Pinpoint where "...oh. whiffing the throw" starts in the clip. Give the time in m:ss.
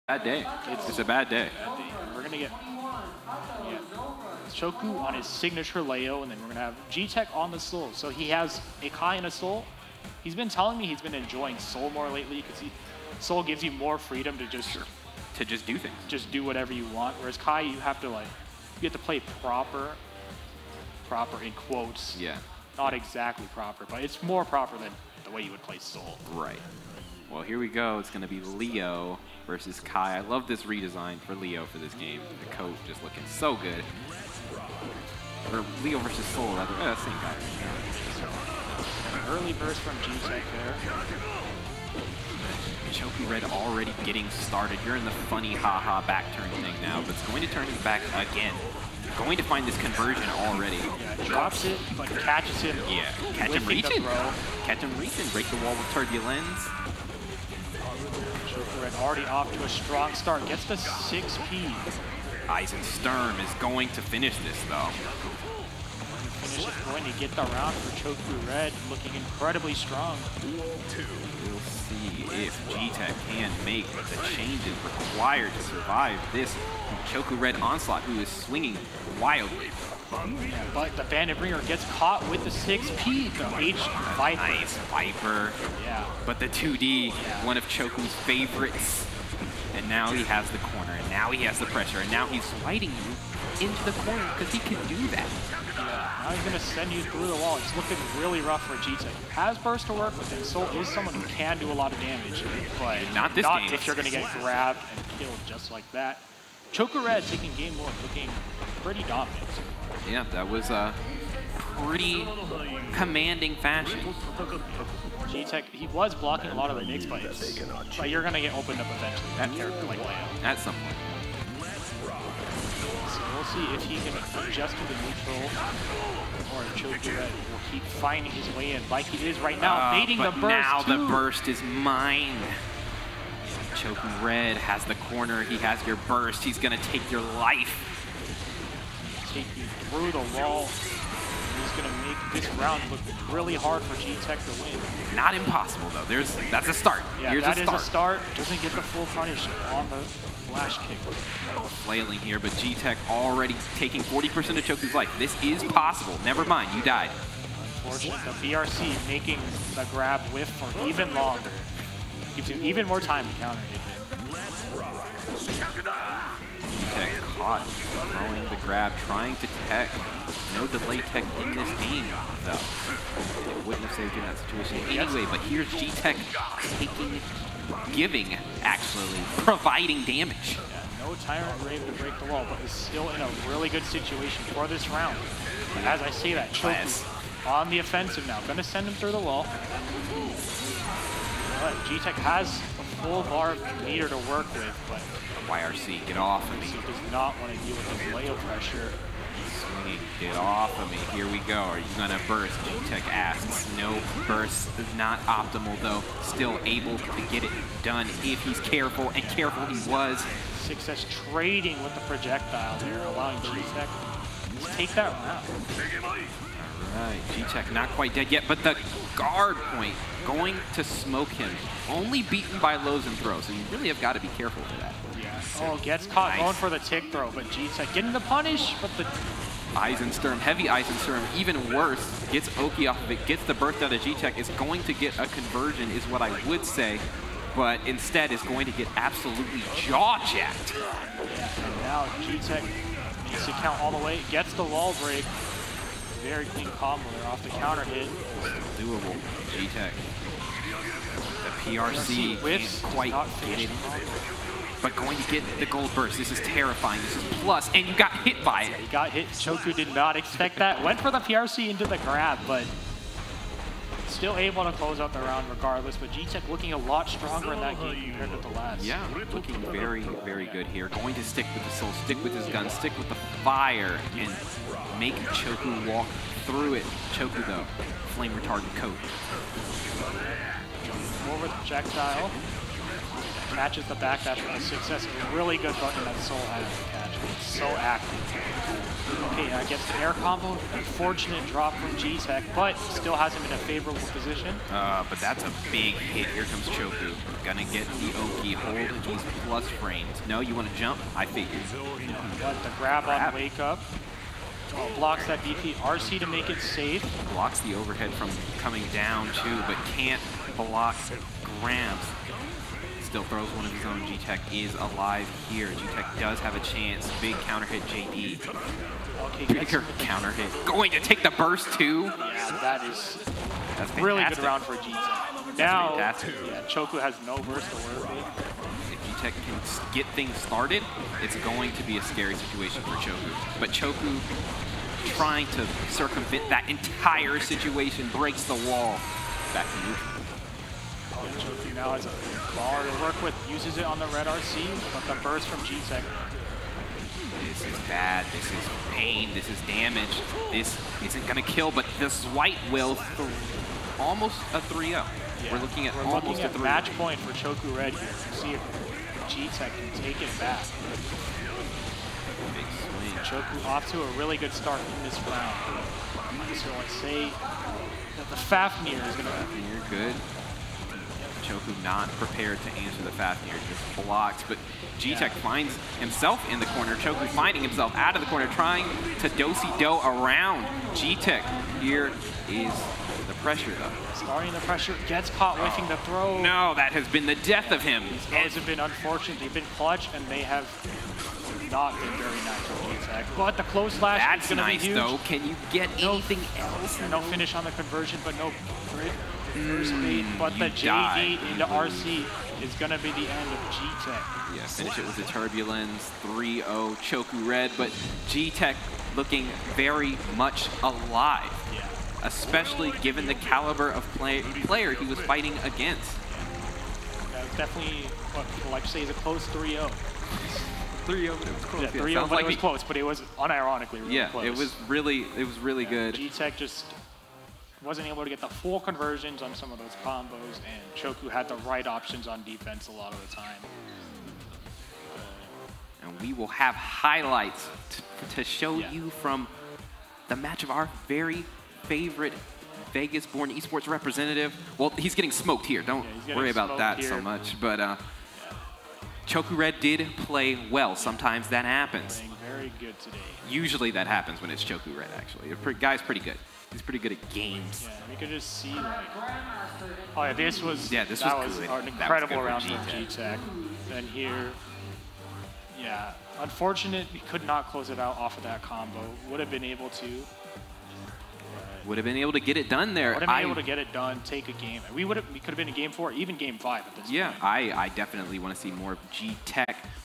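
6:25.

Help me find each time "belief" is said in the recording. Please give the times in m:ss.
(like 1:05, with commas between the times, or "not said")
not said.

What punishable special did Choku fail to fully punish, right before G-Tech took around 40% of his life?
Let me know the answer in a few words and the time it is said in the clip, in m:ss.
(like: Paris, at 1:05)
flash kick, at 2:30.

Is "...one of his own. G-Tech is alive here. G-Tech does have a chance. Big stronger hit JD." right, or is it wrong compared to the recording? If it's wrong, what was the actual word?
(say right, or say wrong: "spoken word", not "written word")
wrong: "counter", not "stronger".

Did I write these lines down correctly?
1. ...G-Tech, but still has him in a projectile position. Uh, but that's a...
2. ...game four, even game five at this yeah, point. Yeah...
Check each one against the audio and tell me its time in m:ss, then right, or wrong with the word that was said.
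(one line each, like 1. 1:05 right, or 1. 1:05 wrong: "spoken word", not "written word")
1. 4:51 wrong: "favorable", not "projectile"
2. 7:55 right.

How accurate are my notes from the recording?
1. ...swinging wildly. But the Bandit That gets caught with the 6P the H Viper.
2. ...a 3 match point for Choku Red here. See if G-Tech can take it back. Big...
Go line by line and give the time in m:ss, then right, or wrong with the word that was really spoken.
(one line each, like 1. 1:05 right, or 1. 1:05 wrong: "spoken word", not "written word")
1. 1:18 wrong: "Bringer", not "That"
2. 5:56 right.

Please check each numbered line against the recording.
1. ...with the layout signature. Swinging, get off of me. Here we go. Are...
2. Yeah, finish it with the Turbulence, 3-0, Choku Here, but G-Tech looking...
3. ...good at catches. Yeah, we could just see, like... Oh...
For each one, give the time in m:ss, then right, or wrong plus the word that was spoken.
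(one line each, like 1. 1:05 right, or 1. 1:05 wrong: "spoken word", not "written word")
1. 3:17 wrong: "pressure", not "signature"
2. 6:44 wrong: "Red", not "Here"
3. 7:36 wrong: "games", not "catches".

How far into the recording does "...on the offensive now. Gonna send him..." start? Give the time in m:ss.
3:07.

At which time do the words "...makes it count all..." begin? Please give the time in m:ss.
4:03.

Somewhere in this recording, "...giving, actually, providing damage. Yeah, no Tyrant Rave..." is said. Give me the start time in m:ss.
2:57.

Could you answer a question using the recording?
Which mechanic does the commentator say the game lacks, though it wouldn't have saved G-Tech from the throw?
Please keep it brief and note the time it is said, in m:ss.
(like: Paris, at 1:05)
delay tech, at 2:50.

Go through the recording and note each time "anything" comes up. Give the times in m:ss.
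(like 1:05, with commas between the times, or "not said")
2:43, 6:36.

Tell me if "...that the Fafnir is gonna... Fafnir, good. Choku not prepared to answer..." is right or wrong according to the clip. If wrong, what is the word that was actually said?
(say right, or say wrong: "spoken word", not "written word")
right.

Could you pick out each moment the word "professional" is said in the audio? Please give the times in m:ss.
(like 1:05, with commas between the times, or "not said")
not said.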